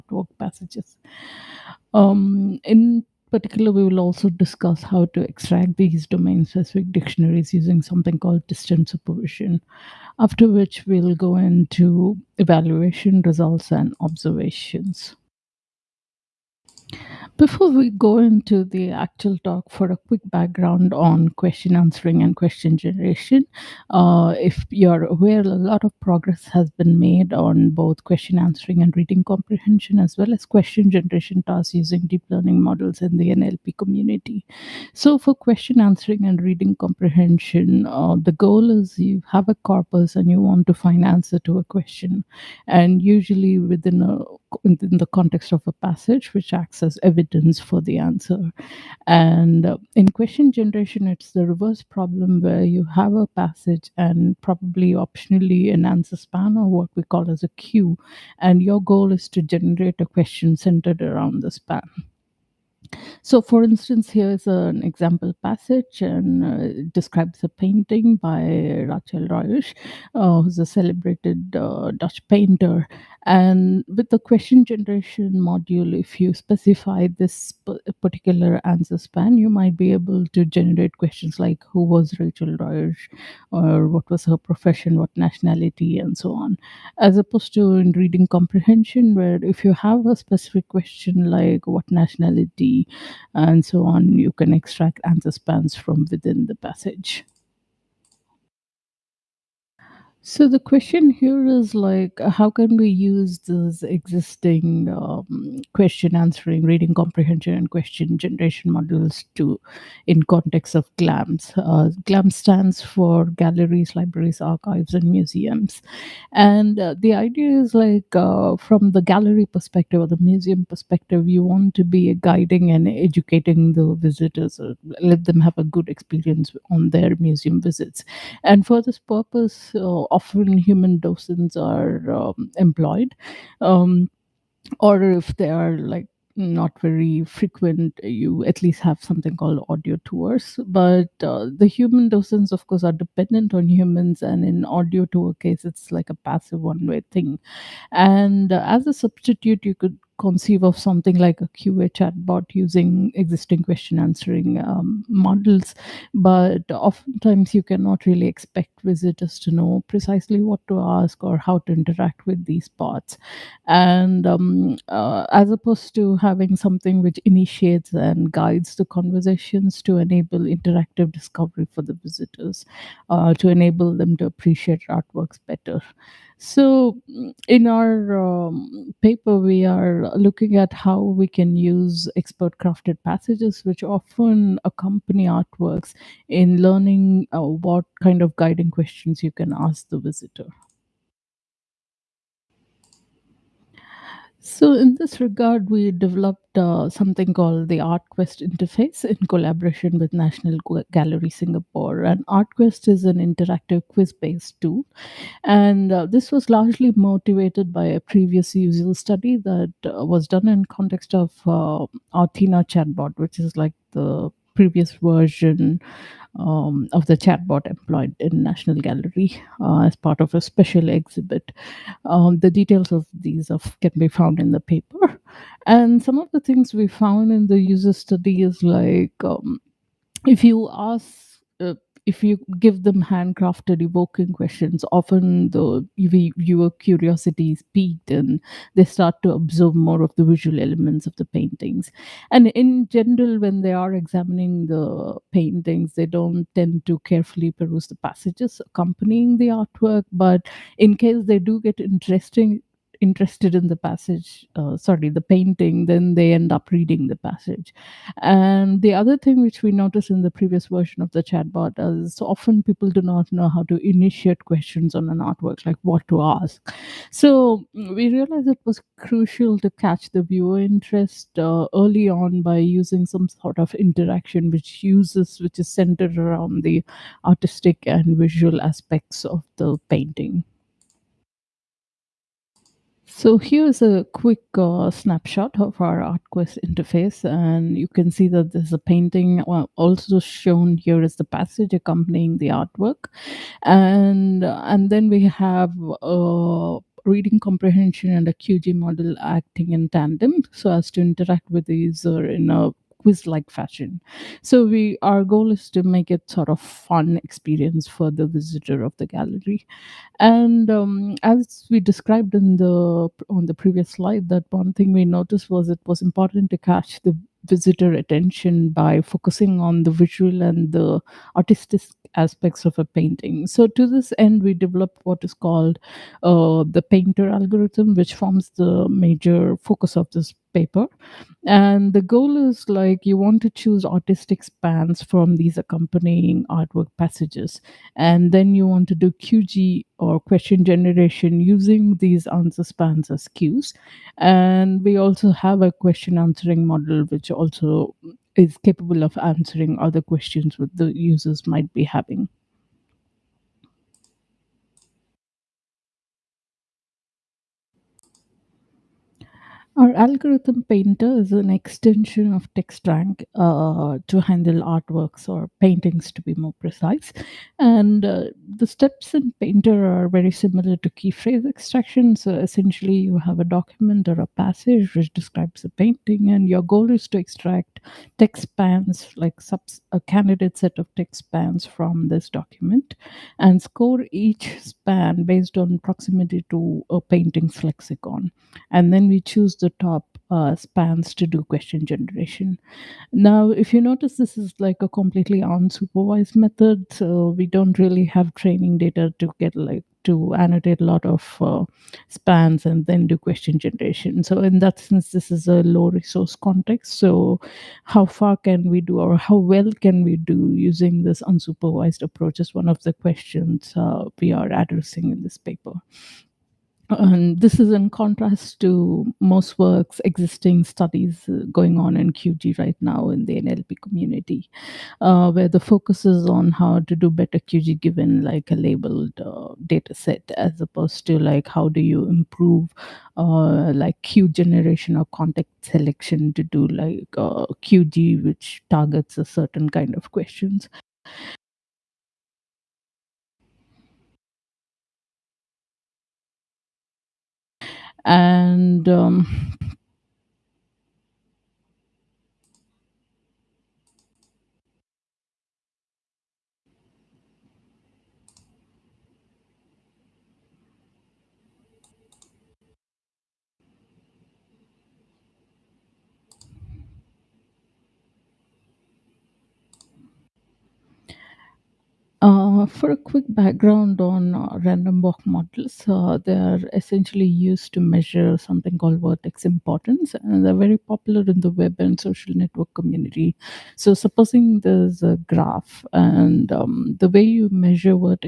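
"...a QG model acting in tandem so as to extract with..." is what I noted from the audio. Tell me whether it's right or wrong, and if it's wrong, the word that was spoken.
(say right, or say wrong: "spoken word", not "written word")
wrong: "interact", not "extract".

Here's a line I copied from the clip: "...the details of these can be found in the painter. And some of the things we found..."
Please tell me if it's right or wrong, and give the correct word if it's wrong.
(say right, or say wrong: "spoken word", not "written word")
wrong: "paper", not "painter".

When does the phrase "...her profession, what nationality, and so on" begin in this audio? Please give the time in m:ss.
1:24.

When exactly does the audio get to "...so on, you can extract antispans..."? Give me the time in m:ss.
1:33.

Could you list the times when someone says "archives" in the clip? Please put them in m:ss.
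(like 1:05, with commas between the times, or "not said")
1:54.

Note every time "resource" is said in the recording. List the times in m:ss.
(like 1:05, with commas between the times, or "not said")
6:45.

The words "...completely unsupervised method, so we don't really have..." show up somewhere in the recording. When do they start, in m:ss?
6:34.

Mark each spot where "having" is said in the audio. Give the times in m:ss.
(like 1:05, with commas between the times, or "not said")
2:46, 5:51.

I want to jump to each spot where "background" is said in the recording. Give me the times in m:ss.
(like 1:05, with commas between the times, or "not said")
0:20, 7:53.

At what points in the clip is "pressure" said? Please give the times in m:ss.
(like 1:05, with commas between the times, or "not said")
not said.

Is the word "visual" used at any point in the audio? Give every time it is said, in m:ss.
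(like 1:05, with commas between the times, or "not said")
4:00, 4:38, 5:19.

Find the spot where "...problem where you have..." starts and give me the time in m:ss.
0:51.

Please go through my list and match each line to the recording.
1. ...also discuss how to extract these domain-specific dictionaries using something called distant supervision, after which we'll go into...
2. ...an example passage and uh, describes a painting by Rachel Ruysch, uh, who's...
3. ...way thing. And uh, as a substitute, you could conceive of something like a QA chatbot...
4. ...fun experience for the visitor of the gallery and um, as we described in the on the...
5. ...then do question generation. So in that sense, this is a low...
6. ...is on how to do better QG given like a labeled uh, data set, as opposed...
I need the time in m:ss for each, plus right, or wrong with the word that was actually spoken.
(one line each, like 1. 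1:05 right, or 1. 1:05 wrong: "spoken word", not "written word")
1. 0:03 right
2. 1:04 right
3. 2:26 right
4. 5:06 right
5. 6:42 right
6. 7:06 right.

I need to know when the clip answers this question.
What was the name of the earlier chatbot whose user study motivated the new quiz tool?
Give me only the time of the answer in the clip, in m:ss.
3:32.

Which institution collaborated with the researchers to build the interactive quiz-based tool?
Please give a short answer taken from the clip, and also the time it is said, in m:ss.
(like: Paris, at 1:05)
National Gallery Singapore, at 3:20.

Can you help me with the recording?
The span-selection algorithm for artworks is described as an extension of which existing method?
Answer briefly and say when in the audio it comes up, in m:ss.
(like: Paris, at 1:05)
TextRank, at 6:02.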